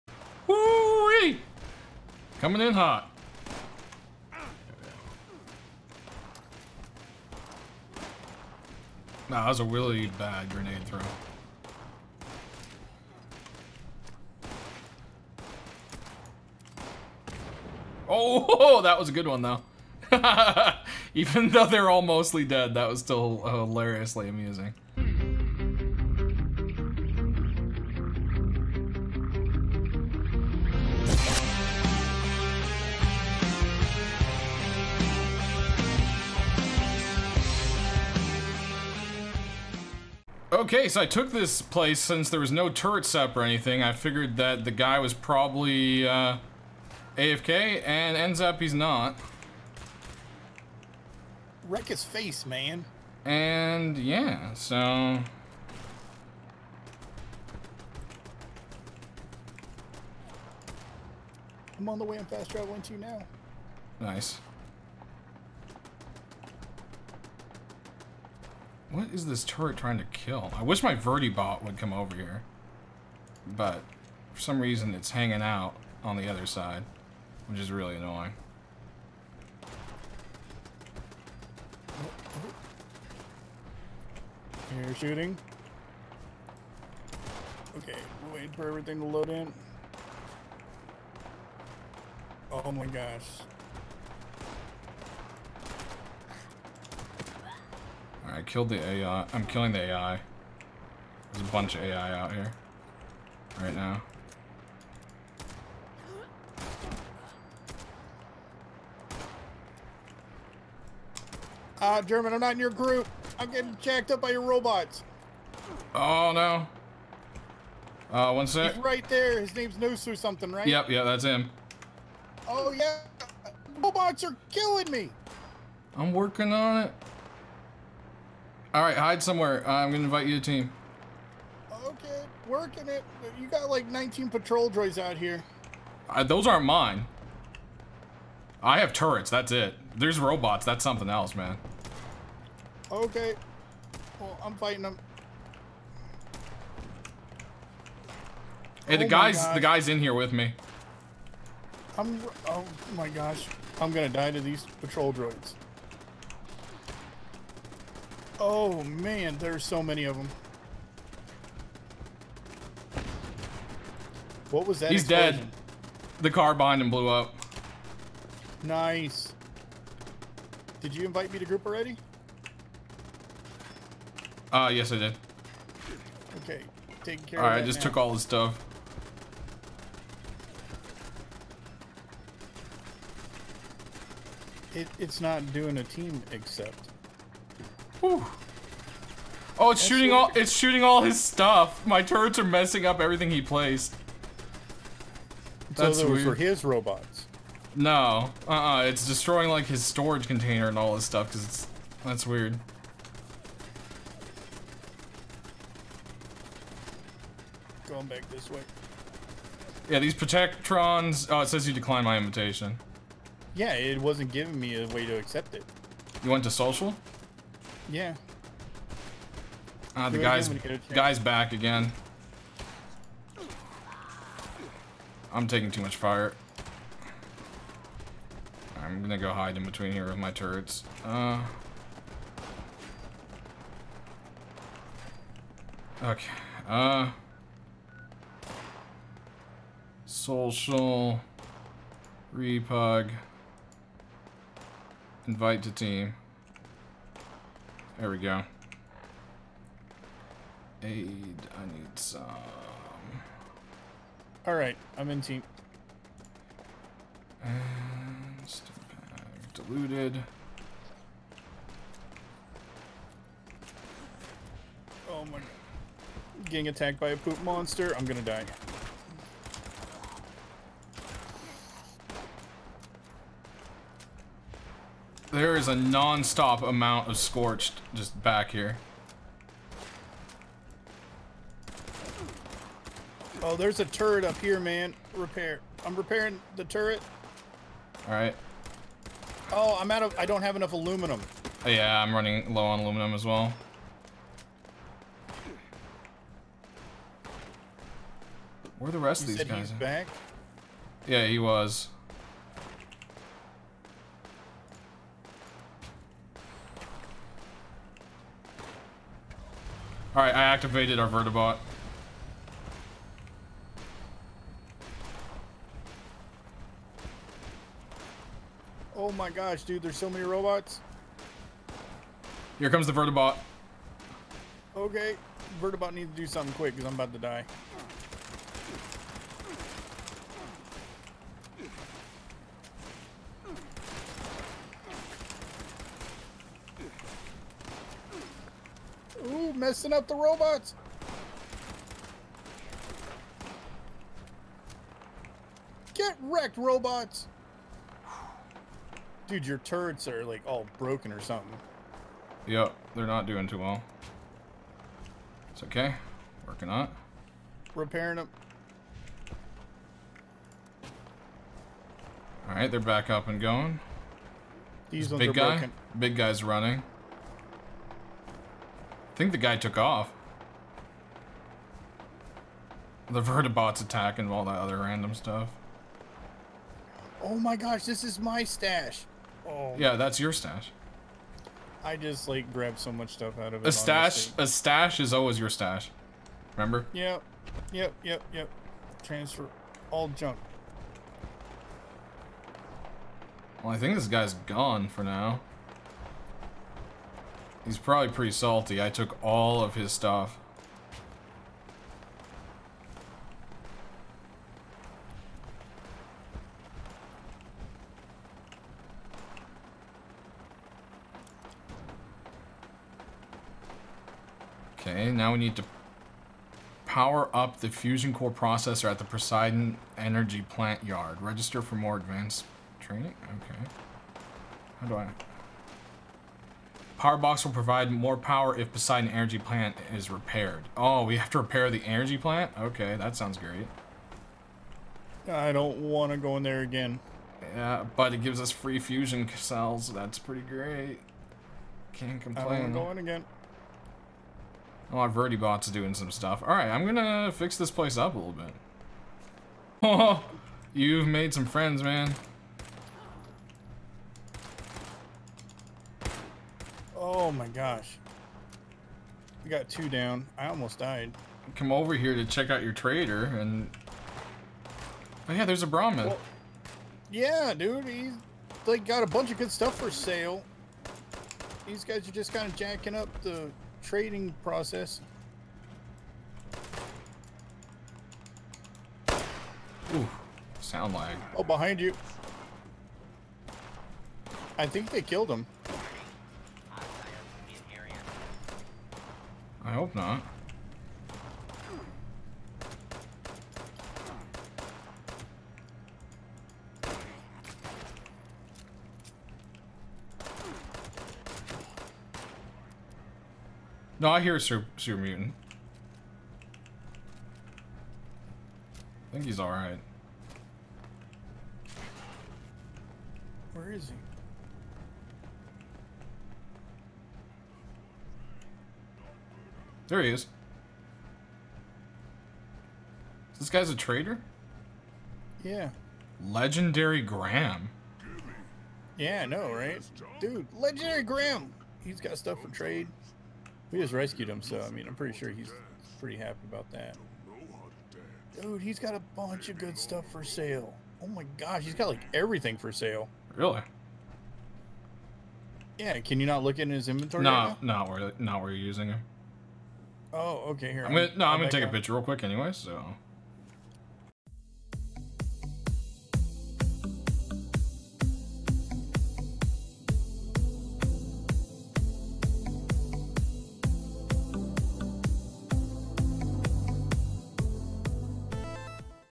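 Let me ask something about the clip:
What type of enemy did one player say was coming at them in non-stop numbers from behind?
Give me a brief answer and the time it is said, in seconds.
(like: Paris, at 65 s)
Scorched, at 277 s.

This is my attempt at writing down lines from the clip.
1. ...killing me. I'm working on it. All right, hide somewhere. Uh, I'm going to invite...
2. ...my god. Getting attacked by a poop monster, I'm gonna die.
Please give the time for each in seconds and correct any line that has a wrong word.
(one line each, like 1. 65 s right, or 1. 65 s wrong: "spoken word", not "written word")
1. 124 s right
2. 265 s right.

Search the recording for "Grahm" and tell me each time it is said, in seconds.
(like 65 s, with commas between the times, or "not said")
527 s, 531 s.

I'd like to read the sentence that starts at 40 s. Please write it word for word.
Okay, so I took this place since there was no turrets up or anything.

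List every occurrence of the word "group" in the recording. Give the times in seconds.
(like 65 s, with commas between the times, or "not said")
112 s, 171 s.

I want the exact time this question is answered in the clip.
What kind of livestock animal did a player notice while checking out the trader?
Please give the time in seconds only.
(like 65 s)
465 s.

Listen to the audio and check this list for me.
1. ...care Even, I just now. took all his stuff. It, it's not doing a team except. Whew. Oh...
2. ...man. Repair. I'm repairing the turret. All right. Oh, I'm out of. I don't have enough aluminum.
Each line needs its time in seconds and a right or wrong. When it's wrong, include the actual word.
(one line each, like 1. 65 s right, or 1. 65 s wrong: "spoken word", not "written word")
1. 177 s wrong: "Alright", not "Even"
2. 284 s right.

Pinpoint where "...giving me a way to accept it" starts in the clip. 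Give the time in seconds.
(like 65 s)
214 s.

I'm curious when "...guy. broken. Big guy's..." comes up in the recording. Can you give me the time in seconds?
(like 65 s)
365 s.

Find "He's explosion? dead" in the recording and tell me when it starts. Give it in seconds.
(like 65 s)
164 s.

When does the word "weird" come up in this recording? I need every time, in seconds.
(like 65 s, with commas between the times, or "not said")
196 s, 202 s.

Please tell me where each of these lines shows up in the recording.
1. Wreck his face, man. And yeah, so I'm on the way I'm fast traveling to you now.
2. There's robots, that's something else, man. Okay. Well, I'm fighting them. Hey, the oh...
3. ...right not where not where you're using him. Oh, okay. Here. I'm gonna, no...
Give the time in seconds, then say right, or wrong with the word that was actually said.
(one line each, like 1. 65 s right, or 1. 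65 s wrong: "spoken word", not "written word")
1. 51 s right
2. 139 s right
3. 547 s right.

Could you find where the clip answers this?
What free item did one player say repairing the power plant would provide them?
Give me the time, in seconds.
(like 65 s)
438 s.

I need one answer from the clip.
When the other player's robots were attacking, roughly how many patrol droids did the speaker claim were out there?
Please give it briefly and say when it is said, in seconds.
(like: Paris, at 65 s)
19, at 133 s.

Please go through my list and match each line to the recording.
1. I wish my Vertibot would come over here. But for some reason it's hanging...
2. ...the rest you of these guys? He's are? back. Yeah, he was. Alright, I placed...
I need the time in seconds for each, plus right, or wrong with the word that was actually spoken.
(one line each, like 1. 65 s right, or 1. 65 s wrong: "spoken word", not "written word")
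1. 70 s right
2. 298 s wrong: "activated", not "placed".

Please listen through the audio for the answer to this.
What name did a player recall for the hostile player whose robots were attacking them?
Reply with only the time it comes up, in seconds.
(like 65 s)
119 s.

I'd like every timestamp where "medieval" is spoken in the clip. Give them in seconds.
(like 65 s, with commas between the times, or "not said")
not said.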